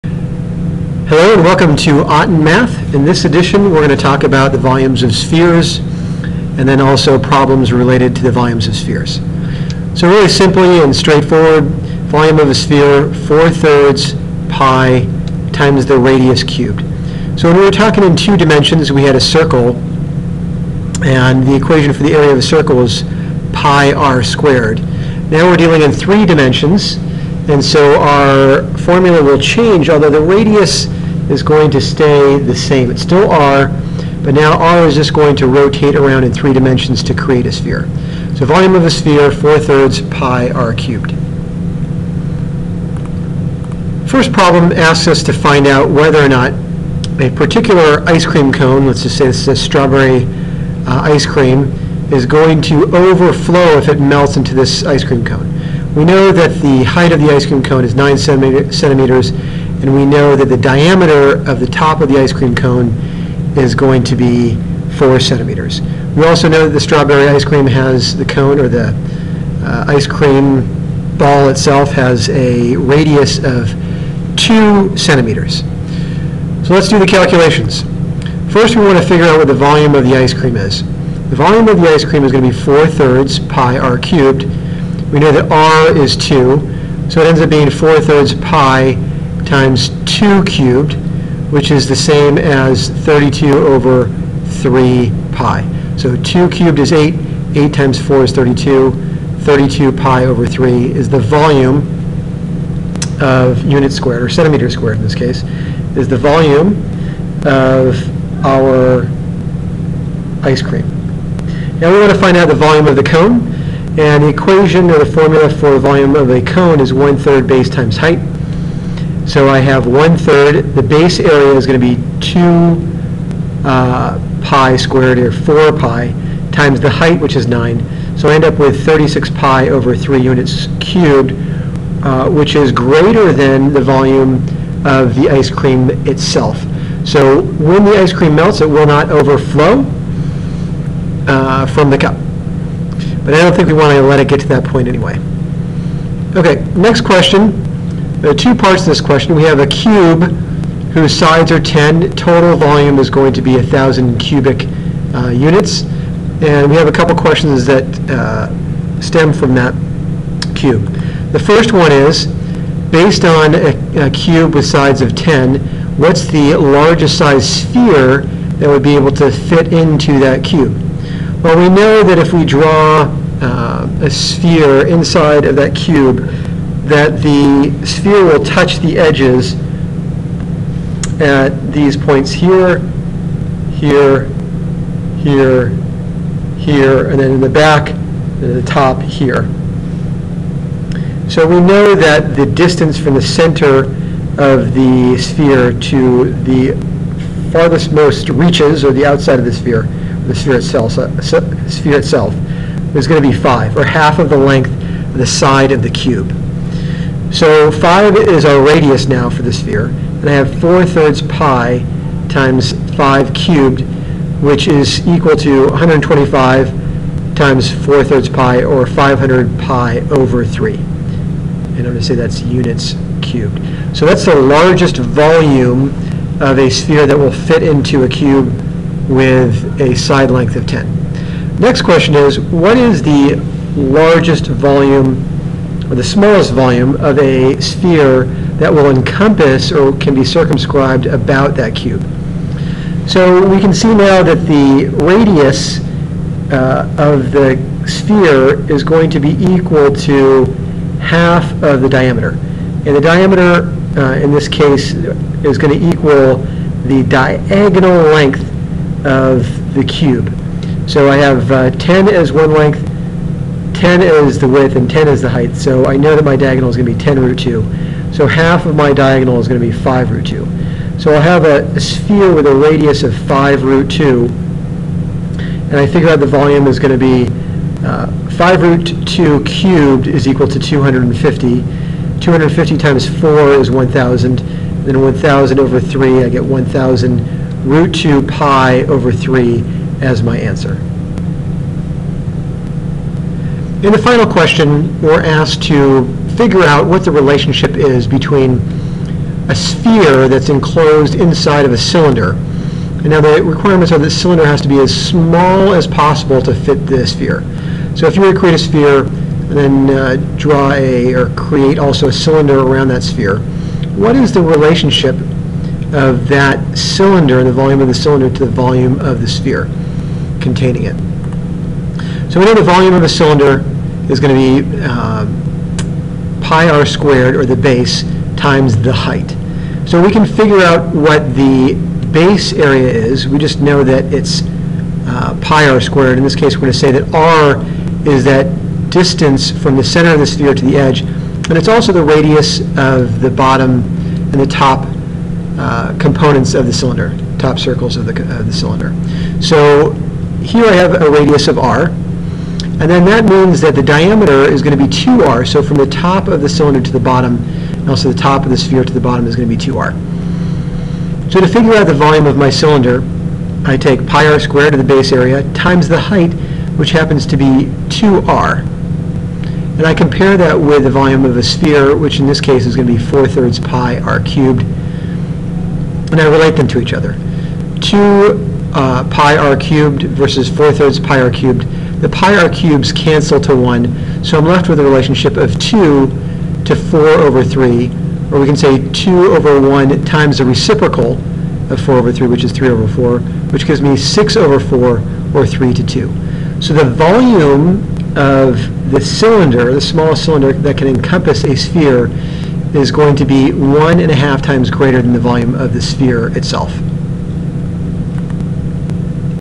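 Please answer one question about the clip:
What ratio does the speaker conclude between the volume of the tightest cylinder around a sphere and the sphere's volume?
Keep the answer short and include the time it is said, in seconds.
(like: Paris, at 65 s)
3 to 2, at 395 s.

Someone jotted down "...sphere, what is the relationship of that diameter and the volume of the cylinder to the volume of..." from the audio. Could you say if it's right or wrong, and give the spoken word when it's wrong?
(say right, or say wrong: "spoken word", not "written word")
wrong: "cylinder", not "diameter".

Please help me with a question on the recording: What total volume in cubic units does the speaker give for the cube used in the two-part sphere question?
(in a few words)
1,000.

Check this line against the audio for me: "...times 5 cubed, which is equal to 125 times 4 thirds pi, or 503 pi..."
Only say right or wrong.
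wrong.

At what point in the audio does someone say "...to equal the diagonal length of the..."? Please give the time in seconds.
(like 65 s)
255 s.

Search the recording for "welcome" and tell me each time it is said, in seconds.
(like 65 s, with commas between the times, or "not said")
1 s.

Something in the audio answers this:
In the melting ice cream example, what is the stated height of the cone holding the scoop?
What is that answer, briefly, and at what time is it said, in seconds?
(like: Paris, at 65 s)
9 centimeters, at 57 s.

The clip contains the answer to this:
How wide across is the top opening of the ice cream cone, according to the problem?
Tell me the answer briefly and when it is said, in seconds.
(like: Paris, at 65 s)
4 centimeters, at 64 s.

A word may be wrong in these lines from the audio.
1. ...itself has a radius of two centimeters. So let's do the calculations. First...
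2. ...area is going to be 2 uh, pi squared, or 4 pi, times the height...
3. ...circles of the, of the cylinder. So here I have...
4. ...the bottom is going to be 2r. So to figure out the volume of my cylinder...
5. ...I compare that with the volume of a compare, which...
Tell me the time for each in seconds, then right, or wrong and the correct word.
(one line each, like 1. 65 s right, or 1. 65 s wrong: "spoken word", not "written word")
1. 71 s right
2. 121 s right
3. 347 s right
4. 358 s right
5. 369 s wrong: "sphere", not "compare".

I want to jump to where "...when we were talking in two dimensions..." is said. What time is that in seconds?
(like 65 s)
17 s.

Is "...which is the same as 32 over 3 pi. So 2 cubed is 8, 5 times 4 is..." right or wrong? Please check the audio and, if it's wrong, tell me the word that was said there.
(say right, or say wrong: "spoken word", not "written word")
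wrong: "8", not "5".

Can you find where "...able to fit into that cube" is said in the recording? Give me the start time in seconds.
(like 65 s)
168 s.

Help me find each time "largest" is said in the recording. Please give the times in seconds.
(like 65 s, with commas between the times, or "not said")
166 s, 224 s, 233 s.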